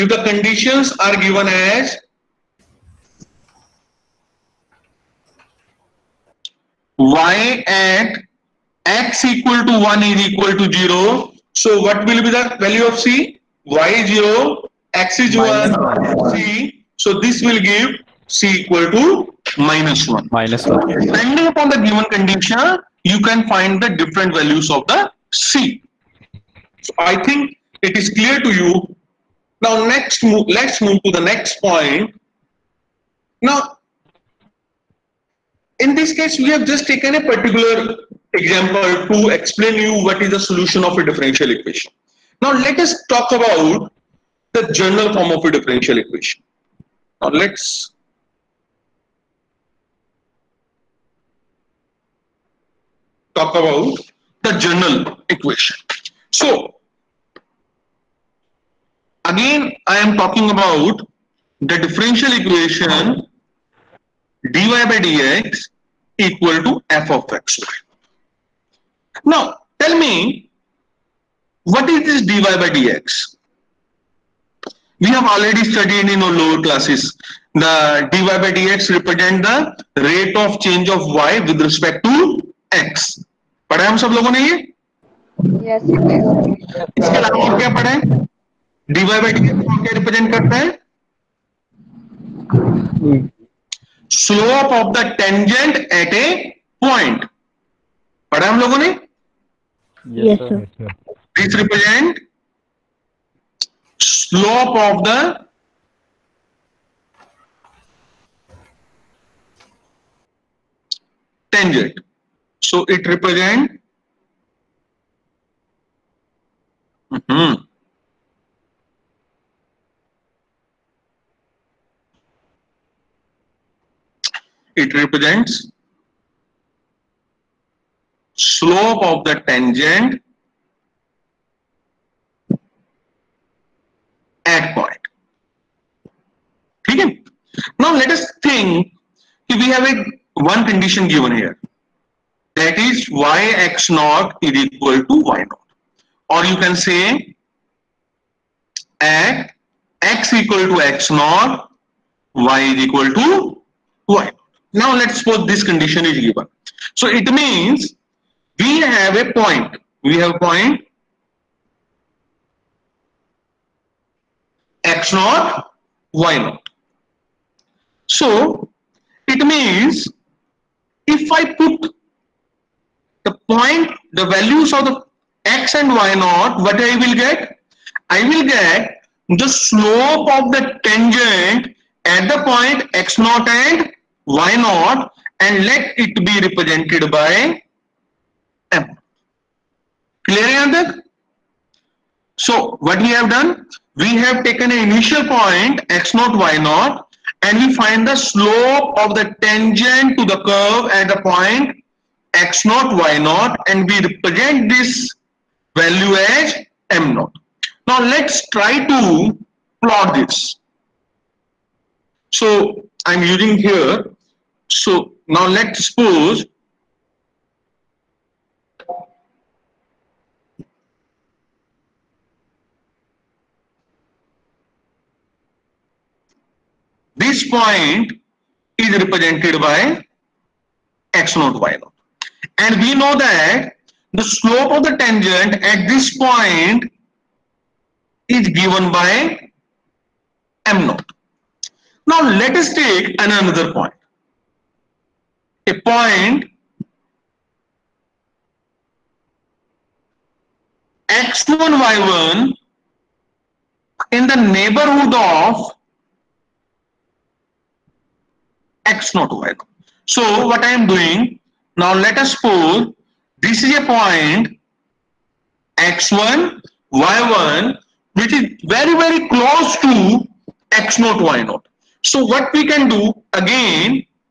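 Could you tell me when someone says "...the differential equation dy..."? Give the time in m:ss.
1:01.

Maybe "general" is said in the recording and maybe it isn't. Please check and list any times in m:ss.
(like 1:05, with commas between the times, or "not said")
0:44, 0:54.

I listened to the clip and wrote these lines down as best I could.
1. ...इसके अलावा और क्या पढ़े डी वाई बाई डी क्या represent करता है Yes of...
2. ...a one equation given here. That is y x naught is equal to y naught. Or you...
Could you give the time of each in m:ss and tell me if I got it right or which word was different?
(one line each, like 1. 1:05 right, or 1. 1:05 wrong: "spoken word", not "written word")
1. 1:25 wrong: "Slope", not "Yes"
2. 2:19 wrong: "condition", not "equation".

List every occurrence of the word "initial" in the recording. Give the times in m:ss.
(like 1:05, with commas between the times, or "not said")
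3:14.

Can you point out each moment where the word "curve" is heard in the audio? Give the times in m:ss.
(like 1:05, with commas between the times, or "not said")
3:20.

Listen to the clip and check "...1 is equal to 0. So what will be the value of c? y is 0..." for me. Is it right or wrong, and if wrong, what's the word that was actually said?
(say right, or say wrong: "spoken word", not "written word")
right.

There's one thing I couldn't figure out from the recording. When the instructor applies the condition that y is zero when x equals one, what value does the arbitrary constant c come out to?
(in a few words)
-1.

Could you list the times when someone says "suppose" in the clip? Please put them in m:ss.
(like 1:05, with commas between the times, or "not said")
2:35, 3:35, 4:22.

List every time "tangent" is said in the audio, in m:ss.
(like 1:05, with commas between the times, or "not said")
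1:35, 1:51, 2:09, 3:00, 3:19, 3:54.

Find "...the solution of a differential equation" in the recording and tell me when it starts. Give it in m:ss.
0:40.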